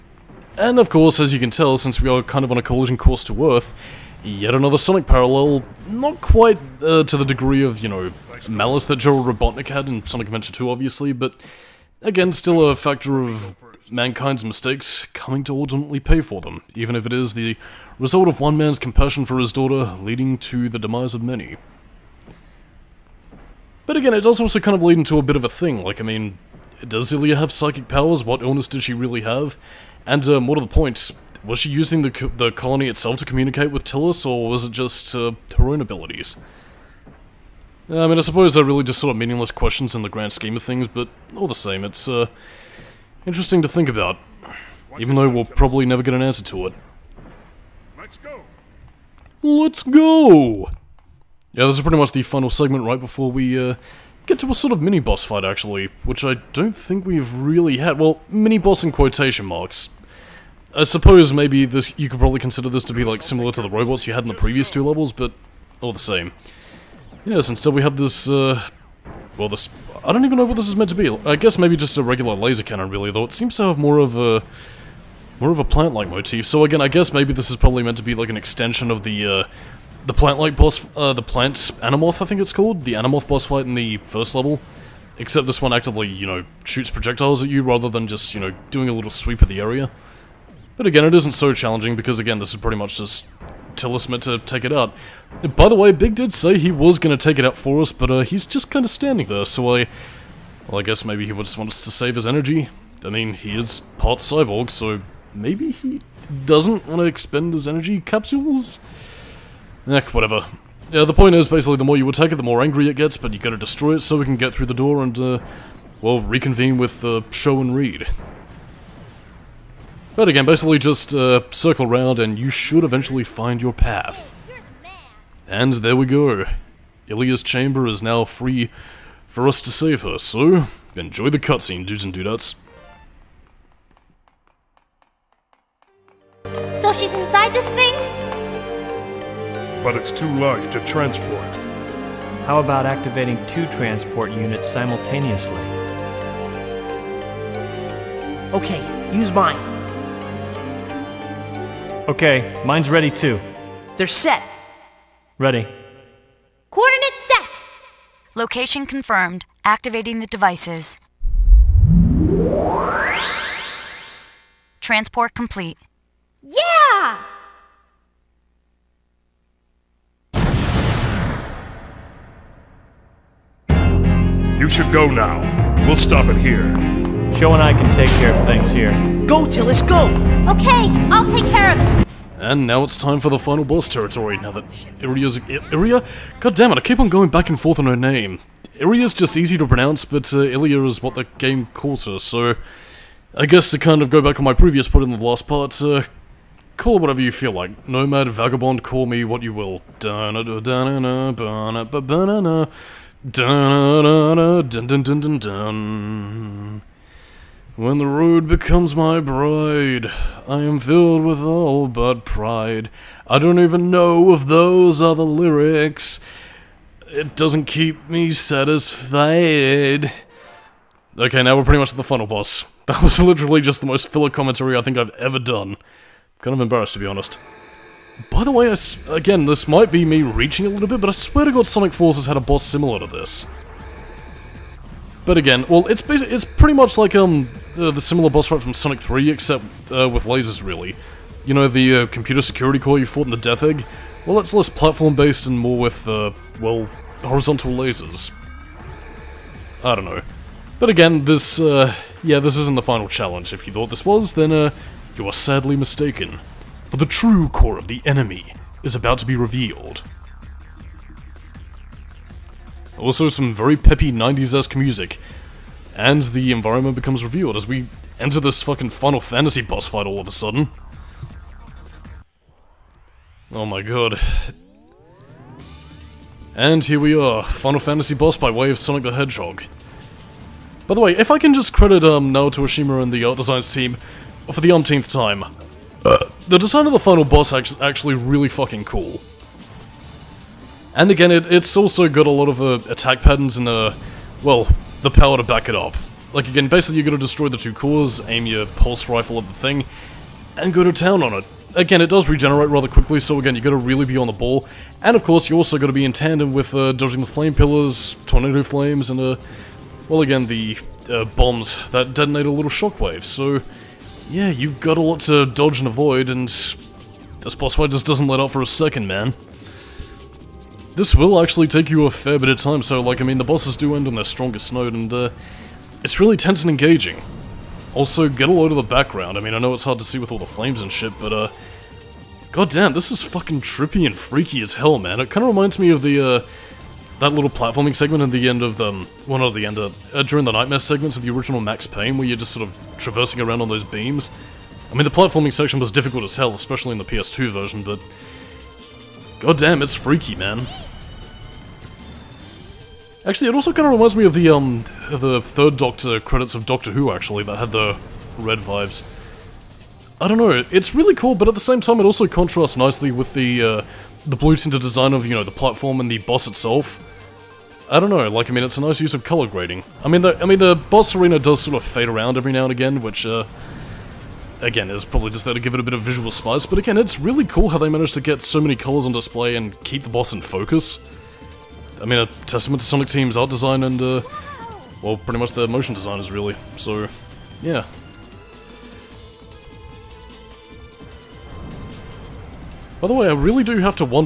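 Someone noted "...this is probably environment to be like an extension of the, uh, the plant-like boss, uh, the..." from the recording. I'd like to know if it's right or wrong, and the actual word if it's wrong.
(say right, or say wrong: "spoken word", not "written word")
wrong: "meant", not "environment".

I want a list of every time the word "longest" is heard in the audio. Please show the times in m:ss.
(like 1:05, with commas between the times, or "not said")
not said.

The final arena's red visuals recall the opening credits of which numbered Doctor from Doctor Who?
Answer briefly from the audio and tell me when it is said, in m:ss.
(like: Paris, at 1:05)
Third Doctor, at 5:55.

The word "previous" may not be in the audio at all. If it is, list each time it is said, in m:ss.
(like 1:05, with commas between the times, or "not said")
1:04, 3:14.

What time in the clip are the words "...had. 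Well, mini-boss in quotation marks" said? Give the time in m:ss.
0:57.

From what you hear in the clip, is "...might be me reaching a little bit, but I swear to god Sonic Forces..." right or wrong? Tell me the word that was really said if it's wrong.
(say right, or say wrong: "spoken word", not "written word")
right.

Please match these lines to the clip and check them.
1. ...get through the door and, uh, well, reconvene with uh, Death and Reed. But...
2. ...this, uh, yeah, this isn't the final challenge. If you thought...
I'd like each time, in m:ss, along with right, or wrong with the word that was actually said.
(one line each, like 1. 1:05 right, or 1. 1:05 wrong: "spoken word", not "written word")
1. 1:54 wrong: "Show", not "Death"
2. 4:11 right.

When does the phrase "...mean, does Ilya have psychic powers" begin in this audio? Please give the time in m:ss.
0:26.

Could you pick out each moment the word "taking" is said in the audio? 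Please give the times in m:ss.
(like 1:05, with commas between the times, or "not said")
not said.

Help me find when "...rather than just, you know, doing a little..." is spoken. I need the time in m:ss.
1:27.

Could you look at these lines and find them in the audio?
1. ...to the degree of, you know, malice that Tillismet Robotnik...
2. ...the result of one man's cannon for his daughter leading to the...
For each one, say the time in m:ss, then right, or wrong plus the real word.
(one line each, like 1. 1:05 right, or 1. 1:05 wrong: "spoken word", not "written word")
1. 0:07 wrong: "Gerald", not "Tillismet"
2. 0:17 wrong: "compassion", not "cannon".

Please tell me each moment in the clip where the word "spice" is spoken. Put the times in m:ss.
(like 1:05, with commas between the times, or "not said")
6:16.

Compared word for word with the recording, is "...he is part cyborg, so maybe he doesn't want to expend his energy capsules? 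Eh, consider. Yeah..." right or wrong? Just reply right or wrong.
wrong.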